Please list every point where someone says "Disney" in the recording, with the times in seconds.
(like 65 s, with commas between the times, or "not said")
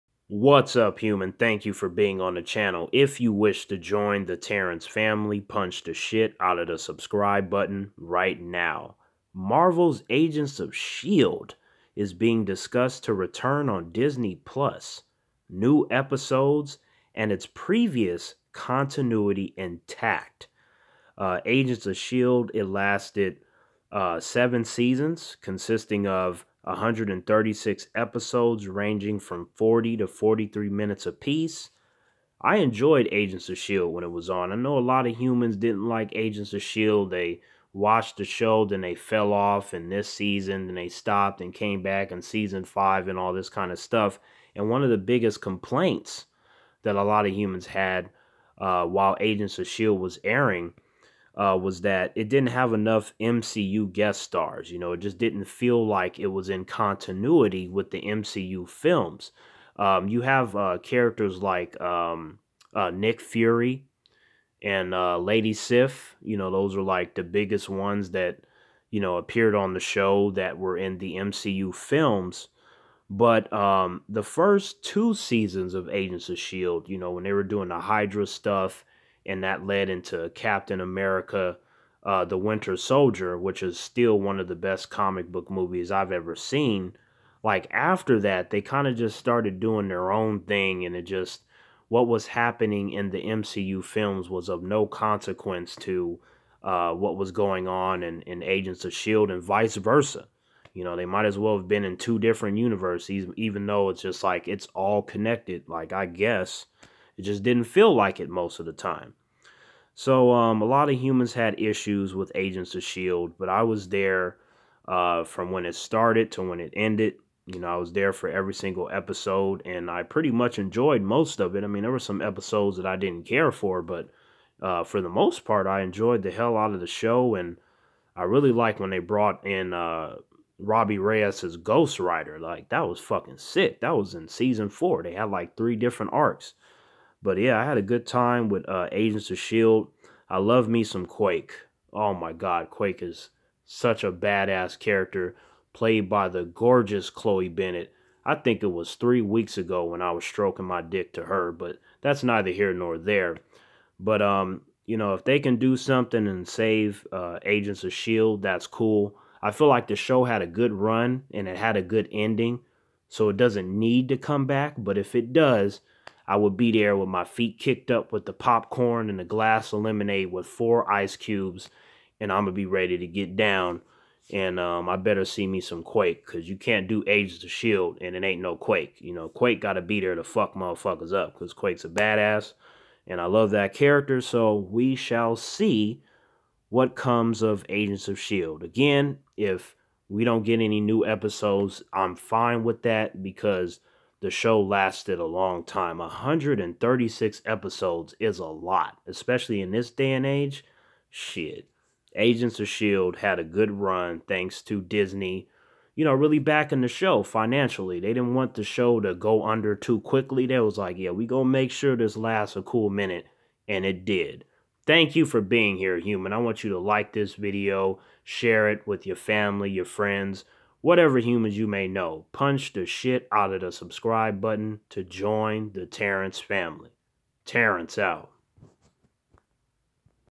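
13 s, 204 s.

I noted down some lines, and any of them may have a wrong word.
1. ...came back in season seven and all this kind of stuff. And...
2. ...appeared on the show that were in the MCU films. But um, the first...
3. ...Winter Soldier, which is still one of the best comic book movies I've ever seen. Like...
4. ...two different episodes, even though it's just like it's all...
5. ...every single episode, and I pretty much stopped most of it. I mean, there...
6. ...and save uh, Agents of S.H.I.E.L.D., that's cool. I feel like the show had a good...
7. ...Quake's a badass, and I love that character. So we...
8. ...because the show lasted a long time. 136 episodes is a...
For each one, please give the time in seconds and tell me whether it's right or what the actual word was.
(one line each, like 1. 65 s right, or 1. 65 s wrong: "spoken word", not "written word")
1. 41 s wrong: "five", not "seven"
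2. 69 s right
3. 82 s right
4. 101 s wrong: "universes", not "episodes"
5. 118 s wrong: "enjoyed", not "stopped"
6. 156 s right
7. 181 s right
8. 193 s right.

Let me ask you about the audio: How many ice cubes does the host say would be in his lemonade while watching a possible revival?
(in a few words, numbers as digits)
4.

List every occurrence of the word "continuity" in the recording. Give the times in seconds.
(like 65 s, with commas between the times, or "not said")
18 s, 56 s.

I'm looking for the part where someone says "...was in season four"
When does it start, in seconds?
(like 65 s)
133 s.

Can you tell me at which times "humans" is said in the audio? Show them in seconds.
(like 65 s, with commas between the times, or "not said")
0 s, 35 s, 47 s, 110 s, 215 s, 221 s.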